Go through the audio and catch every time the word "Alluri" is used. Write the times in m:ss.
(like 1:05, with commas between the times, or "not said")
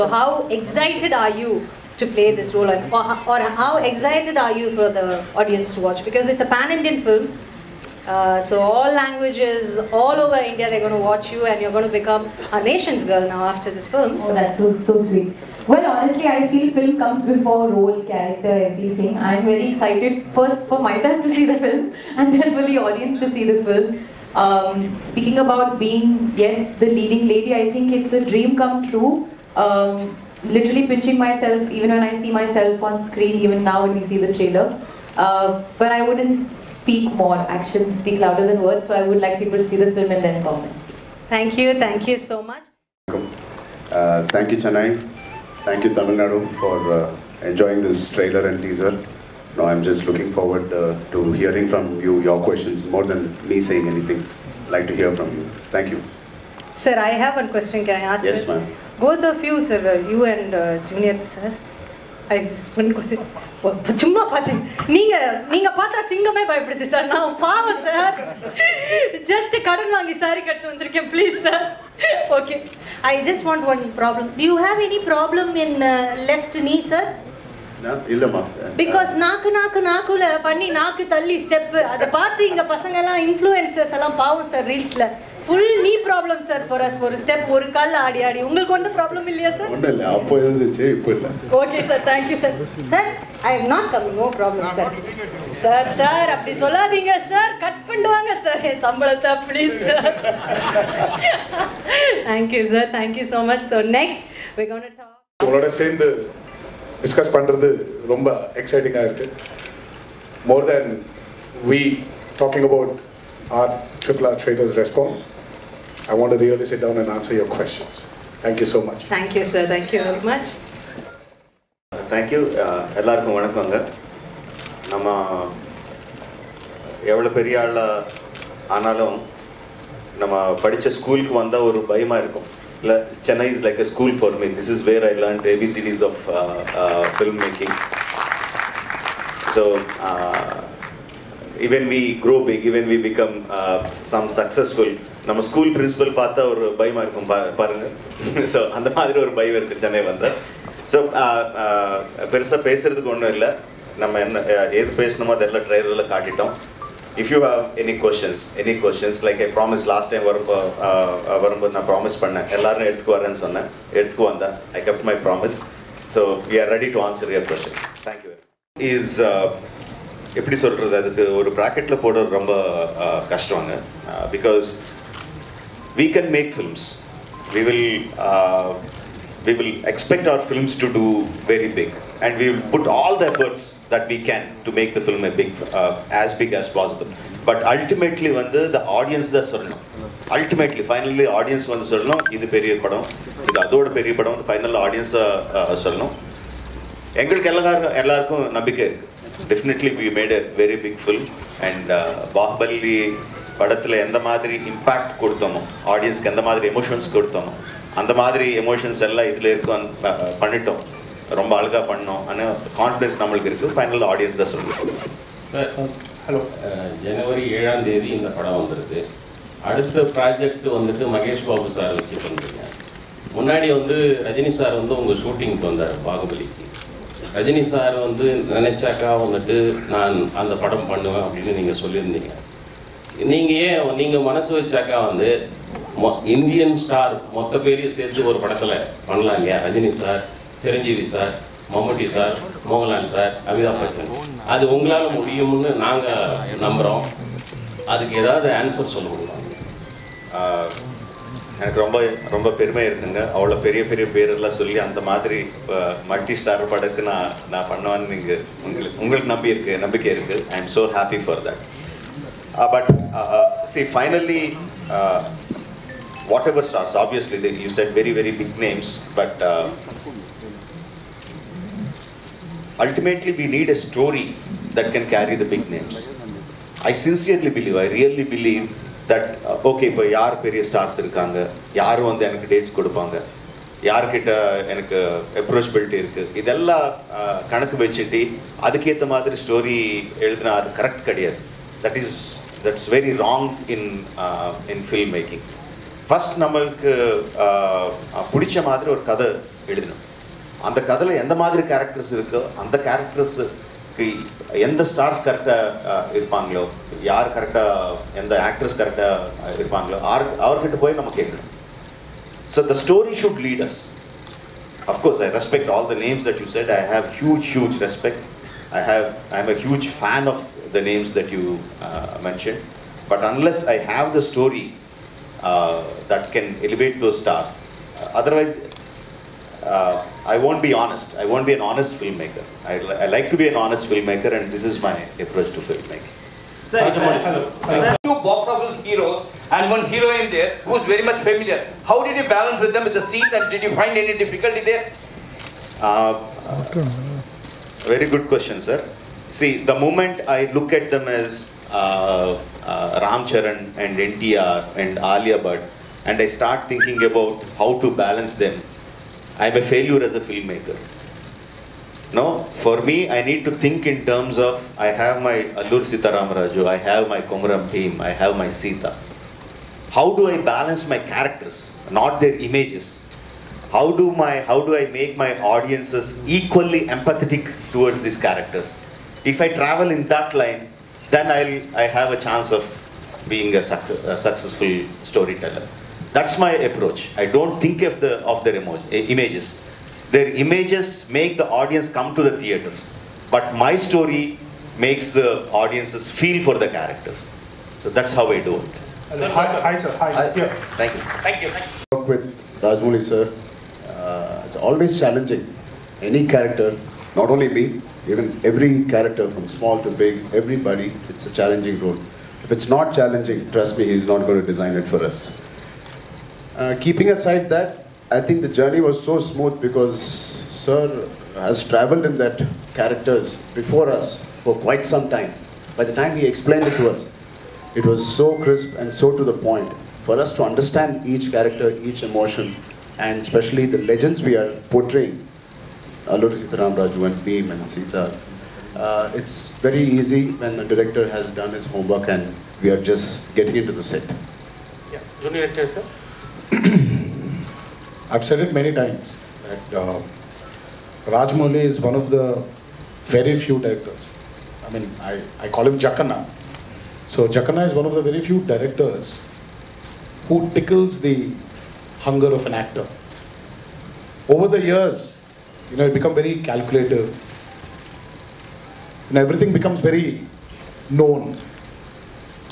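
6:05, 7:16.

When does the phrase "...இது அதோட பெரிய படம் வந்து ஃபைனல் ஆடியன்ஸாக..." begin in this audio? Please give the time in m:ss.
3:13.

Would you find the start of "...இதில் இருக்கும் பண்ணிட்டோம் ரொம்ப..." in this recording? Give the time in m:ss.
3:29.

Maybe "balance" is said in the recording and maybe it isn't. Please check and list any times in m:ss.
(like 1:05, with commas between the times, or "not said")
5:42, 5:57, 6:10.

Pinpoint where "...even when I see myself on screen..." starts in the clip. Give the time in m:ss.
0:31.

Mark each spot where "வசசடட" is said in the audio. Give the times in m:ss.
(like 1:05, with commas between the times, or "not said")
4:47.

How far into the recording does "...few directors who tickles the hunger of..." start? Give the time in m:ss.
7:38.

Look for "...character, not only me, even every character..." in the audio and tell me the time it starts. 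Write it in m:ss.
6:46.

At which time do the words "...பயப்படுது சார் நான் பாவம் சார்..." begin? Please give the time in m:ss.
1:06.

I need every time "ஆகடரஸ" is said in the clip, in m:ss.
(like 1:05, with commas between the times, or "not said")
5:08.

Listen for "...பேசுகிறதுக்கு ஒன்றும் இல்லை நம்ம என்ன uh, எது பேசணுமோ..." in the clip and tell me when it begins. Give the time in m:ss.
2:32.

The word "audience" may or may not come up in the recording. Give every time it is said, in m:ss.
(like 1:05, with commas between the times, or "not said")
0:05, 0:22, 6:15, 6:31, 6:35.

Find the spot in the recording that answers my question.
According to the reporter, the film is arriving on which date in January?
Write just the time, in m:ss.
3:37.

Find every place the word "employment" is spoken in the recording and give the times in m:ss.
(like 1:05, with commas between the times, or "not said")
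not said.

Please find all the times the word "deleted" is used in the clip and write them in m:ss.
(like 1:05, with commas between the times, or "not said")
not said.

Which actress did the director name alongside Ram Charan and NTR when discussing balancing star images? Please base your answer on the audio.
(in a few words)
Alia Bhatt.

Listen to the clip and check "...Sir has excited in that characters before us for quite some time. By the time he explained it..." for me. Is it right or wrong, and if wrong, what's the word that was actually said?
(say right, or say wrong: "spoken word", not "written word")
wrong: "traveled", not "excited".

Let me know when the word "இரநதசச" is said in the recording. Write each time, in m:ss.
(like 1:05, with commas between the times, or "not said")
1:30.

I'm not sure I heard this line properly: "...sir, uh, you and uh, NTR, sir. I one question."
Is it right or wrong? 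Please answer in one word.
wrong.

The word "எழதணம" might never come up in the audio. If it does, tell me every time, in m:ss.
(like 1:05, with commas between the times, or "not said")
4:59.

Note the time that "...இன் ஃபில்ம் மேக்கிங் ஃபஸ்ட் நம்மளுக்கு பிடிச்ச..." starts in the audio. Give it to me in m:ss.
4:54.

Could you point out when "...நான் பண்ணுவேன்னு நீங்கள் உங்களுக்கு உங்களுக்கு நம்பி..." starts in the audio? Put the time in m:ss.
4:17.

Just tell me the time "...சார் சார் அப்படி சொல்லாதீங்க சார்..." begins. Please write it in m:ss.
1:35.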